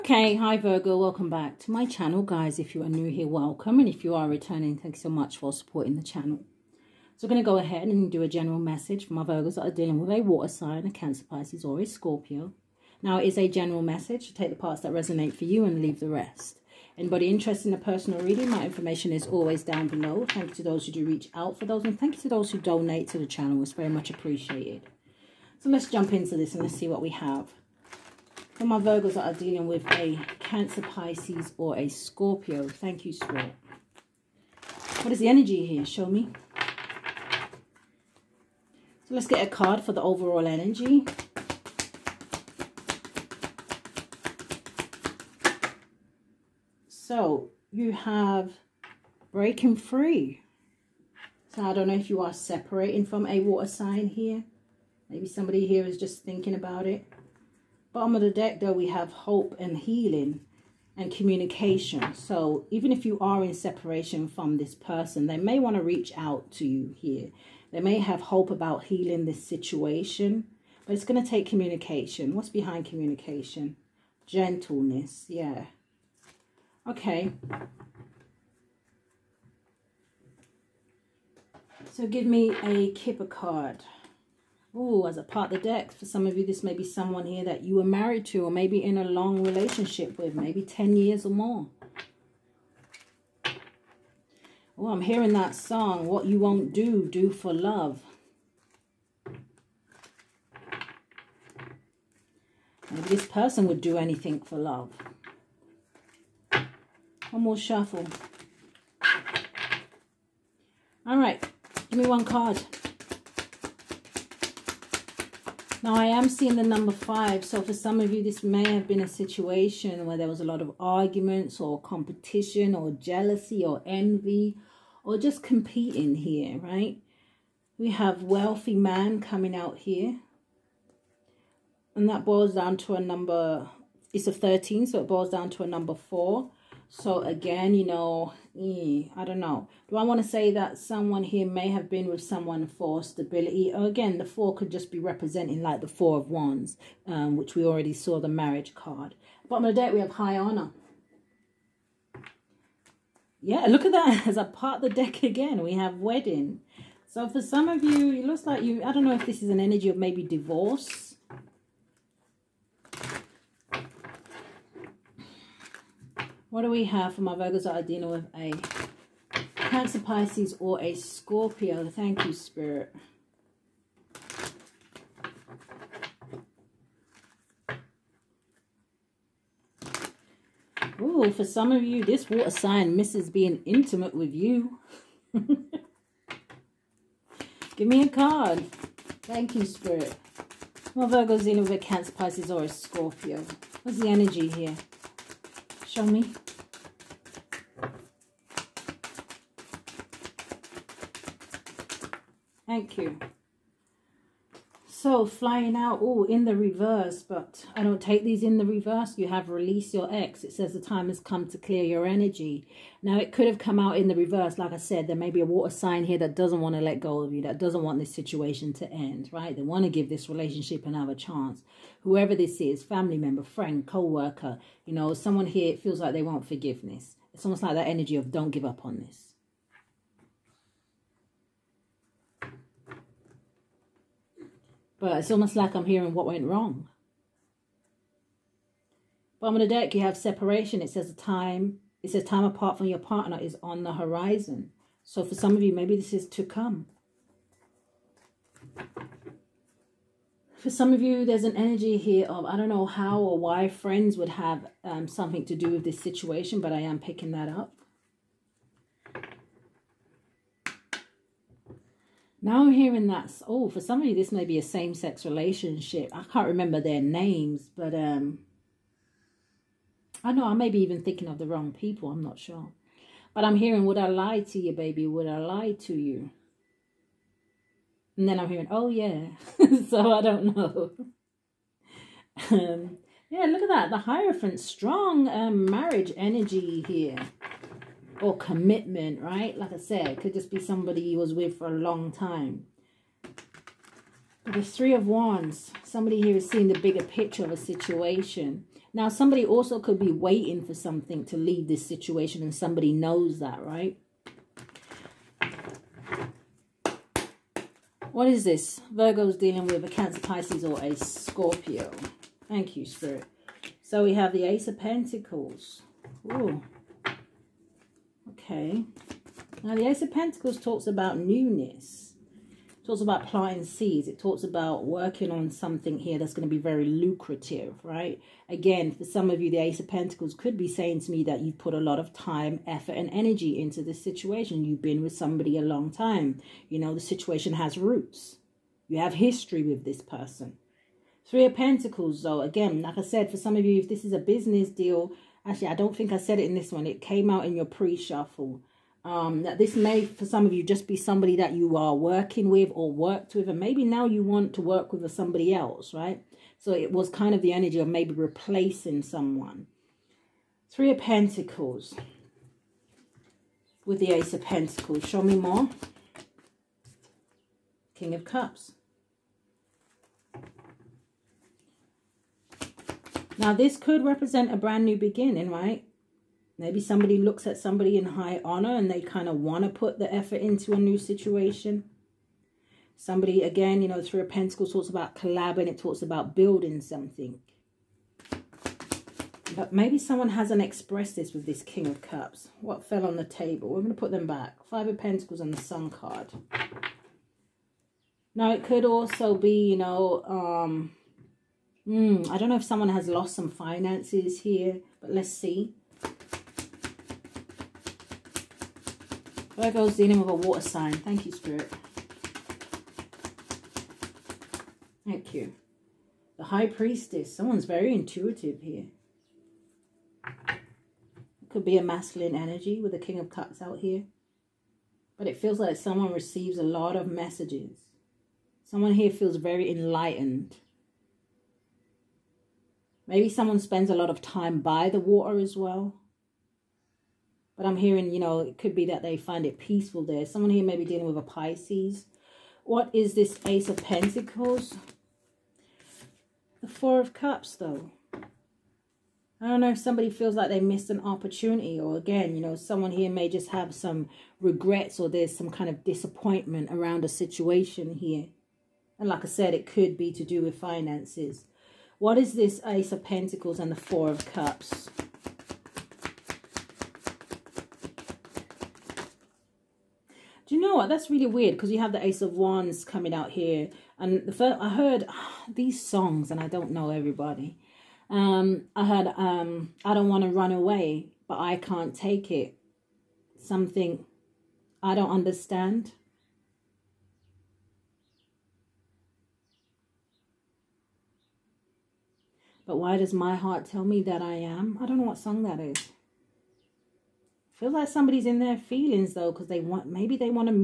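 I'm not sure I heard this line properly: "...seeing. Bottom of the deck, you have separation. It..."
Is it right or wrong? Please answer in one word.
wrong.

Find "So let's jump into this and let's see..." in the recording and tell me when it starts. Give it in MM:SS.
00:25.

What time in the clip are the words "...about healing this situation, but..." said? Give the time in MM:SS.
01:08.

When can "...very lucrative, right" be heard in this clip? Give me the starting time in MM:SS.
05:26.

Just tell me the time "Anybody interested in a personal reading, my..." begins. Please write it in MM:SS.
00:16.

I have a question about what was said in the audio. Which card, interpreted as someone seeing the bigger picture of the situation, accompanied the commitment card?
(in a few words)
Three of Wands.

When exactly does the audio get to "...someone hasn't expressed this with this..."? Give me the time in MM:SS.
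06:29.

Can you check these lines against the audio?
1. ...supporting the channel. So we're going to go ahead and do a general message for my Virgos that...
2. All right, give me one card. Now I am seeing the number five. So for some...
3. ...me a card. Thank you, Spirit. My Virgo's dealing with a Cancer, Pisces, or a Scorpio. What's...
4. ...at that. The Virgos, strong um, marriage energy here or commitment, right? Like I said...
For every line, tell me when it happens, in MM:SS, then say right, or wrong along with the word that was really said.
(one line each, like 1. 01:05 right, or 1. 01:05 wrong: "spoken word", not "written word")
1. 00:05 right
2. 01:51 right
3. 03:07 right
4. 04:43 wrong: "Hierophant", not "Virgos".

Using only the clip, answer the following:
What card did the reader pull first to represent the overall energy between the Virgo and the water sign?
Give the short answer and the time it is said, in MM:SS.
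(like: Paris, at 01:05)
Breaking free, at 00:49.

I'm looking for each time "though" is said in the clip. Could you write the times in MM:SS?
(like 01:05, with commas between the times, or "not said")
00:58, 05:42, 07:27, 08:19.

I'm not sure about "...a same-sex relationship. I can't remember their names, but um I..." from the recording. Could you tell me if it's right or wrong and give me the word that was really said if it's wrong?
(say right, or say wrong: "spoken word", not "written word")
right.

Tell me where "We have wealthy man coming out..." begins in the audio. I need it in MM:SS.
02:07.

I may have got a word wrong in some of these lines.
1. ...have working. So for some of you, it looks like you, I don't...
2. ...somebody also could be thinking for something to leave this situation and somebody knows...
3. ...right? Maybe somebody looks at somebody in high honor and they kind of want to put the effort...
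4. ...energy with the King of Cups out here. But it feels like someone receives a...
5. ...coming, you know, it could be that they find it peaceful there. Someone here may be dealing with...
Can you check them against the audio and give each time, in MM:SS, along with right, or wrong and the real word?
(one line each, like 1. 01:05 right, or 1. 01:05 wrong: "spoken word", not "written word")
1. 02:35 wrong: "wedding", not "working"
2. 04:59 wrong: "waiting", not "thinking"
3. 06:15 right
4. 07:02 right
5. 07:17 wrong: "hearing", not "coming".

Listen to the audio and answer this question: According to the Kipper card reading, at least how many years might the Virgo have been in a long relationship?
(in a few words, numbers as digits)
10.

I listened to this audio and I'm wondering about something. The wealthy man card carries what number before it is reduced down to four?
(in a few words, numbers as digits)
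13.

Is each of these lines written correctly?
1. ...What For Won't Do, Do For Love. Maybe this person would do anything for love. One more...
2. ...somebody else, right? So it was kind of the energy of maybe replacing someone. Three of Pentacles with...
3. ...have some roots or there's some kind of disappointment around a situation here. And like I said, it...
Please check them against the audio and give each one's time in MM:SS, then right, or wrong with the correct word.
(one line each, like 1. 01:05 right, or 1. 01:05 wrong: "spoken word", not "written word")
1. 01:36 wrong: "You", not "For"
2. 05:55 right
3. 07:33 wrong: "regrets", not "roots".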